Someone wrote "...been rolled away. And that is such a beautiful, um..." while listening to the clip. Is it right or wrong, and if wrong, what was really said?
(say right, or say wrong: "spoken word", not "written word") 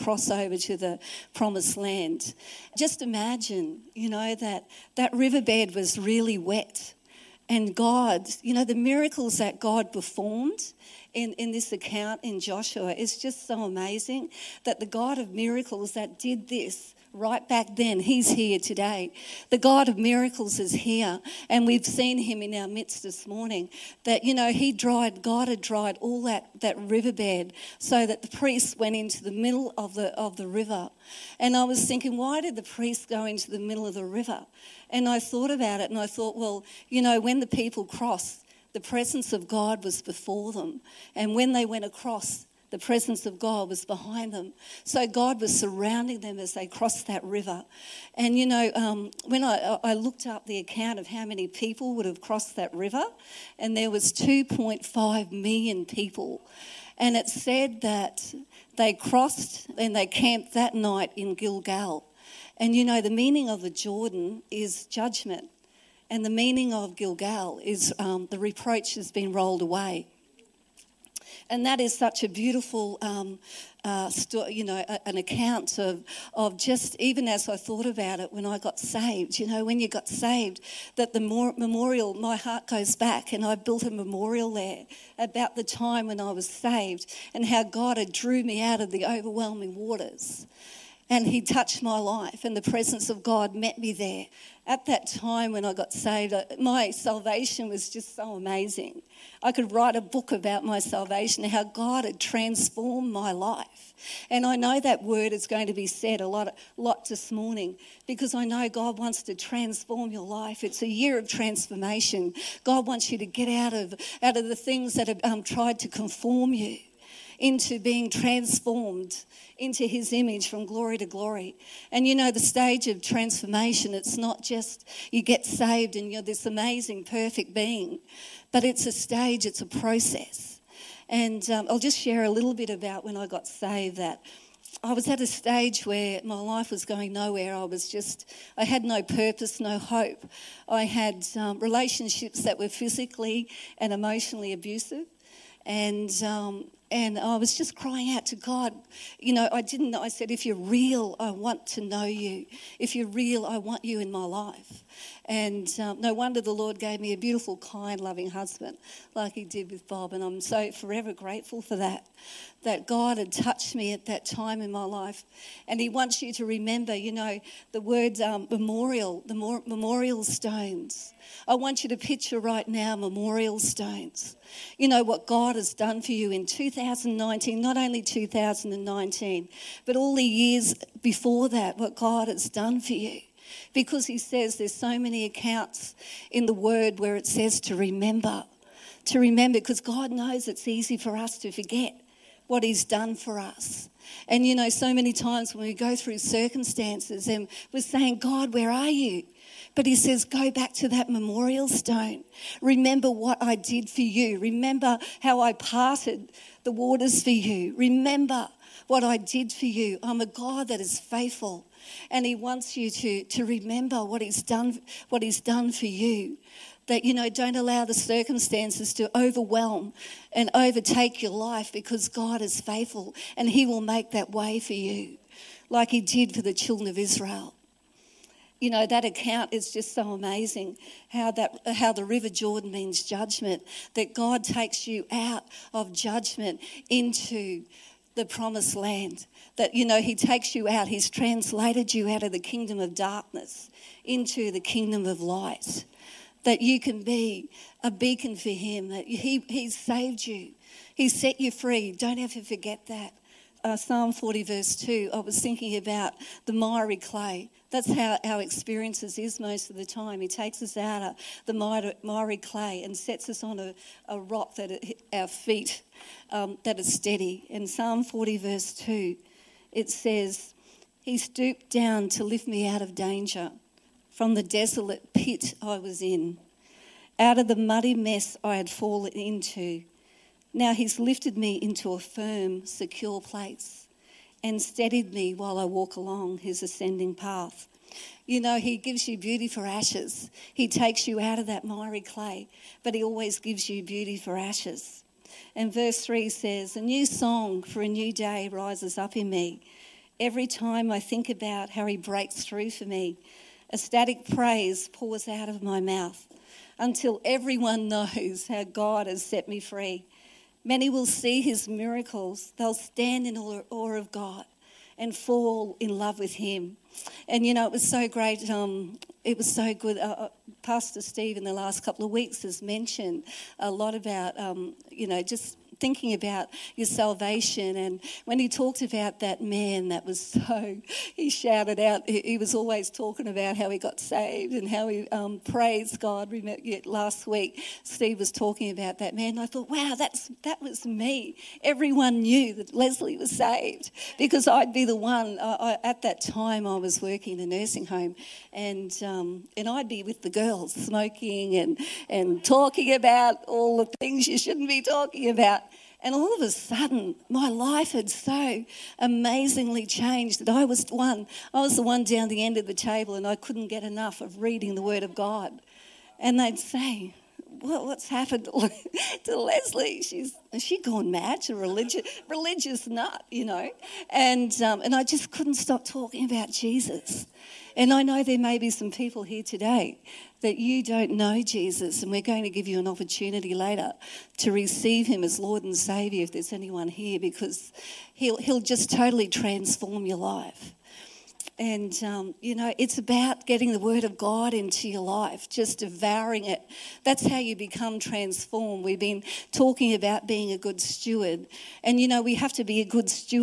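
right.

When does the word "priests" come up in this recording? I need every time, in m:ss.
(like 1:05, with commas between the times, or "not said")
0:28, 0:32.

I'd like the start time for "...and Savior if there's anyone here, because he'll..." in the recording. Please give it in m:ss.
6:25.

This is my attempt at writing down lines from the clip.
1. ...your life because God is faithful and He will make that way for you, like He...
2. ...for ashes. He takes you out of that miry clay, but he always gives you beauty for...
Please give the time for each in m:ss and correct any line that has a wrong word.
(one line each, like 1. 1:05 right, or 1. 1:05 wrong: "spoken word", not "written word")
1. 3:41 right
2. 4:49 right.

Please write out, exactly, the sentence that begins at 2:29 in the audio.
You know, I didn't, I said, if you're real, I want to know you.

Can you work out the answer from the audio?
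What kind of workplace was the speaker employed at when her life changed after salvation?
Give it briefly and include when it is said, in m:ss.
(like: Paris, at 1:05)
A nursing home, at 5:47.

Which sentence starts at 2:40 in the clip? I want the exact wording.
And I'm so forever grateful for that that God had touched me at that time in my life.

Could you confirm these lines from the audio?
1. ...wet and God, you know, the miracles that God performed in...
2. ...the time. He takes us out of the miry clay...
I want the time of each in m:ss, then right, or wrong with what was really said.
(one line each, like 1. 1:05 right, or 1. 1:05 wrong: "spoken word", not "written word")
1. 0:06 right
2. 4:19 right.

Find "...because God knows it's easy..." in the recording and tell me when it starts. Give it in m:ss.
3:09.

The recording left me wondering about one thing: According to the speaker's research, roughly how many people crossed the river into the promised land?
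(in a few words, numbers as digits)
2.5 million.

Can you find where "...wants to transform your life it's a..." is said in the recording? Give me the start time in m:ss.
1:48.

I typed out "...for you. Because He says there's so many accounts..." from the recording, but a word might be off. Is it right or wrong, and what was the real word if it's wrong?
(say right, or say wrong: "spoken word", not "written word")
right.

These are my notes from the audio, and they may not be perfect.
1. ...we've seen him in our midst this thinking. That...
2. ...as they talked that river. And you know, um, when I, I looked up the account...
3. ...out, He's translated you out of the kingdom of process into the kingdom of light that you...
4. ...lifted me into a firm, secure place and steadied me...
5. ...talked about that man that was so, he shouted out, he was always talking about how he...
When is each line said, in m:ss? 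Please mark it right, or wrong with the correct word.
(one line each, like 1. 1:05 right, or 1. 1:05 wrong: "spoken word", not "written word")
1. 0:21 wrong: "morning", not "thinking"
2. 0:46 wrong: "crossed", not "talked"
3. 4:00 wrong: "darkness", not "process"
4. 4:40 right
5. 5:28 right.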